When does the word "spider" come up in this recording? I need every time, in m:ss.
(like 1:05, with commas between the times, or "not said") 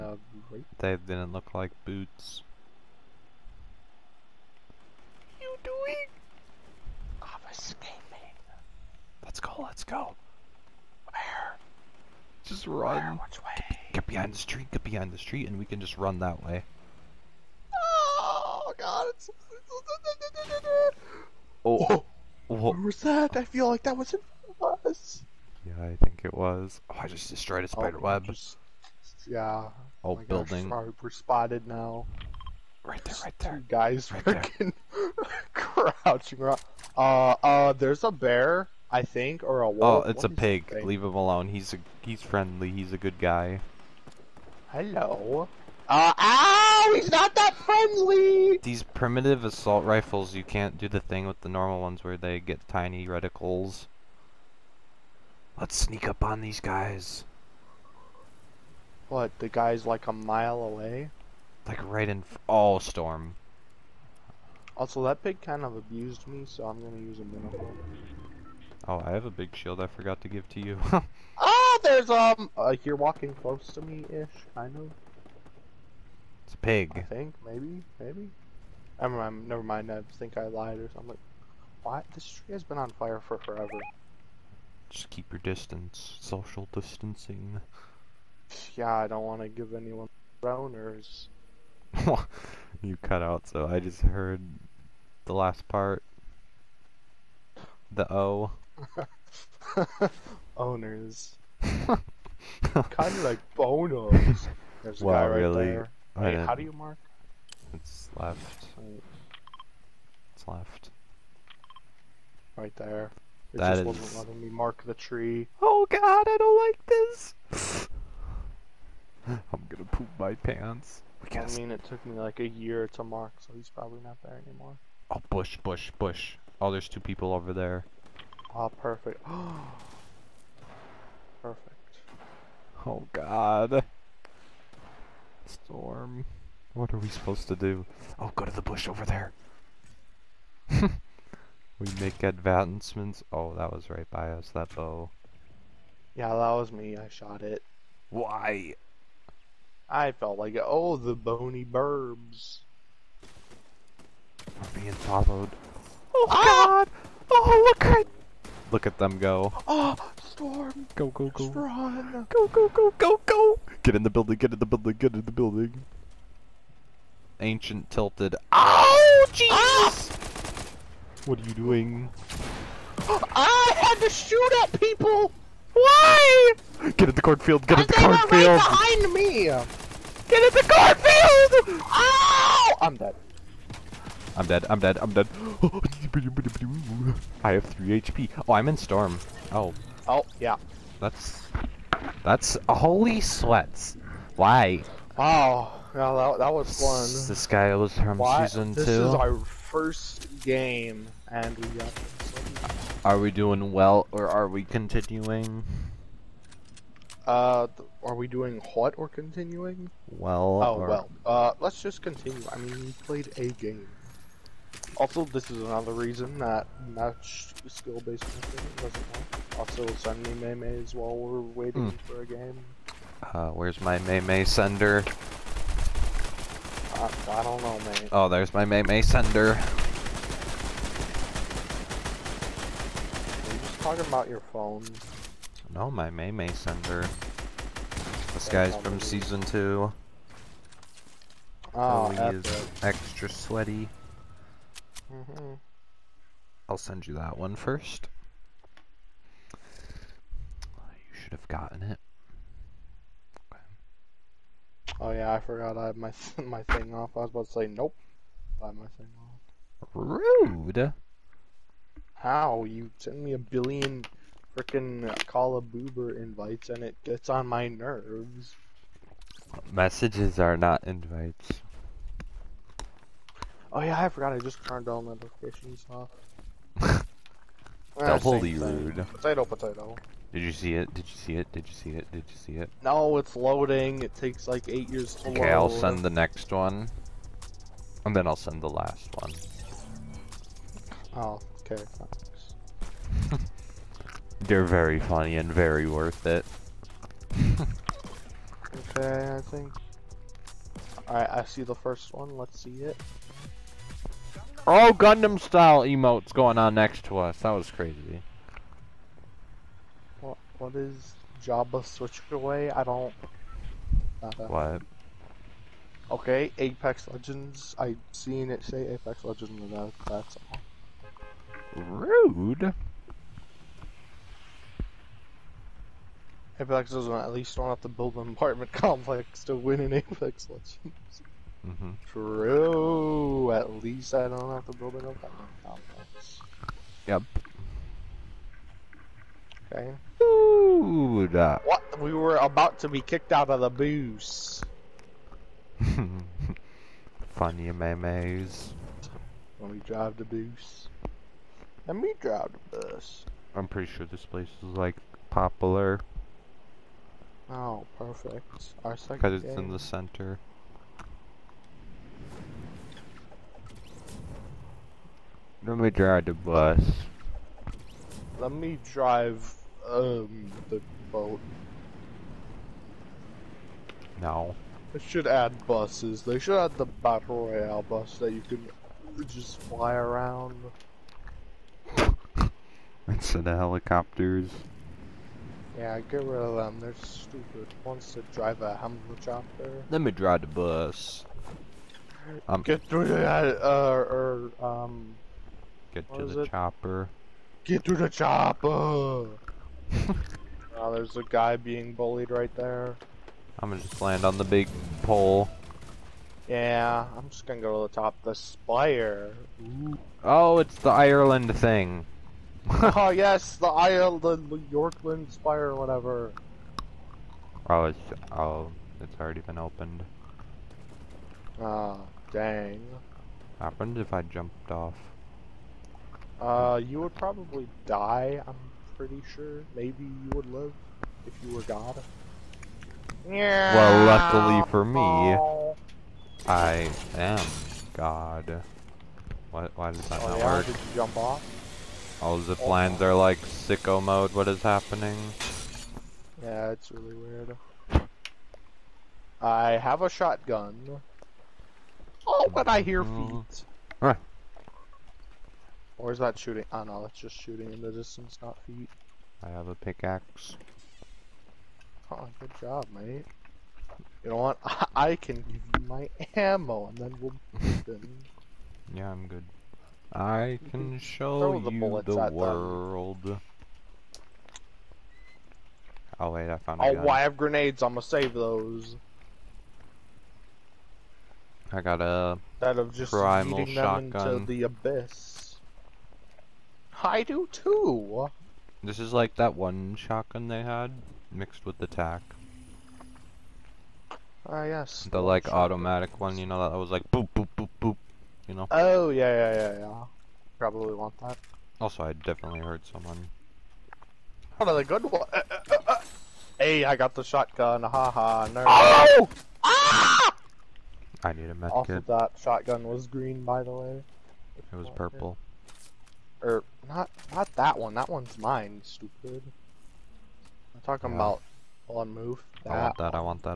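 0:27.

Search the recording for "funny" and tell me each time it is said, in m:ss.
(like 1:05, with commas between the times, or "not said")
4:54, 5:47.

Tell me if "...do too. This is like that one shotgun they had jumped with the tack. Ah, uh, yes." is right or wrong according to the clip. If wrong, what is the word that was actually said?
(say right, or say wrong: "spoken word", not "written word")
wrong: "mixed", not "jumped".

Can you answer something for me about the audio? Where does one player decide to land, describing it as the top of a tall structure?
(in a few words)
The spire.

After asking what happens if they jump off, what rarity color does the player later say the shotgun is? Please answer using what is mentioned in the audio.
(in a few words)
Purple.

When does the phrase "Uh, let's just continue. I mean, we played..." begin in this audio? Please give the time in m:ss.
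3:31.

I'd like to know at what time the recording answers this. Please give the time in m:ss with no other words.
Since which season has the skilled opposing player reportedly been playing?
3:59.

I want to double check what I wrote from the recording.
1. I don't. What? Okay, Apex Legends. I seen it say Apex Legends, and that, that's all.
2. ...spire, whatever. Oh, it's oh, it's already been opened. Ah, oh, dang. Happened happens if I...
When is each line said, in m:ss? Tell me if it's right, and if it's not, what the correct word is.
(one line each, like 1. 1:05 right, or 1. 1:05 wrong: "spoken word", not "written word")
1. 5:12 right
2. 6:55 right.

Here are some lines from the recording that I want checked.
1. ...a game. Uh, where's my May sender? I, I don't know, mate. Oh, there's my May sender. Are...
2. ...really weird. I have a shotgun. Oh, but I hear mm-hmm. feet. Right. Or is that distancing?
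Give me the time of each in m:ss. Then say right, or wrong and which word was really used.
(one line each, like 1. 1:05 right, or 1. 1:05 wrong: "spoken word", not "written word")
1. 3:42 right
2. 7:26 wrong: "shooting", not "distancing".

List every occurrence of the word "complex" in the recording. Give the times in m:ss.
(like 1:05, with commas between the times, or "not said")
5:28, 5:35.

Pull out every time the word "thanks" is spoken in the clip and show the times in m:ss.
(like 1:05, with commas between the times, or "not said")
4:51.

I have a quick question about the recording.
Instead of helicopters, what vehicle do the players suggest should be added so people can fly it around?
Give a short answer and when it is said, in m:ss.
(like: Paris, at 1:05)
Battle royale bus, at 6:16.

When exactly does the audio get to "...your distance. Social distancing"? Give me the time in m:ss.
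1:25.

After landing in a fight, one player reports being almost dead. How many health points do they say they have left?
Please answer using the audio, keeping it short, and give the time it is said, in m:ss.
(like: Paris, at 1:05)
3, at 3:07.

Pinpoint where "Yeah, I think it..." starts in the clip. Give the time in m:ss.
0:25.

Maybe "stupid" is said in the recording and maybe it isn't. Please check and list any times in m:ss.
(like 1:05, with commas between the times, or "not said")
6:27, 8:38.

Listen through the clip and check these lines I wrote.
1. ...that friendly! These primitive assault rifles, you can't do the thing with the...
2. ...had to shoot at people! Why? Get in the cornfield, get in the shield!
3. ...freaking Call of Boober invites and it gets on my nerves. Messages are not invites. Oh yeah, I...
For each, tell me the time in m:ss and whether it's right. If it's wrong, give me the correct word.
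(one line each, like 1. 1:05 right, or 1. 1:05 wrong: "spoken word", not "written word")
1. 0:47 right
2. 2:53 wrong: "cornfield", not "shield"
3. 4:24 right.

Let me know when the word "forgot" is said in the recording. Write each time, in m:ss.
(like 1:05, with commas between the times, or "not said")
1:09, 4:15, 4:34.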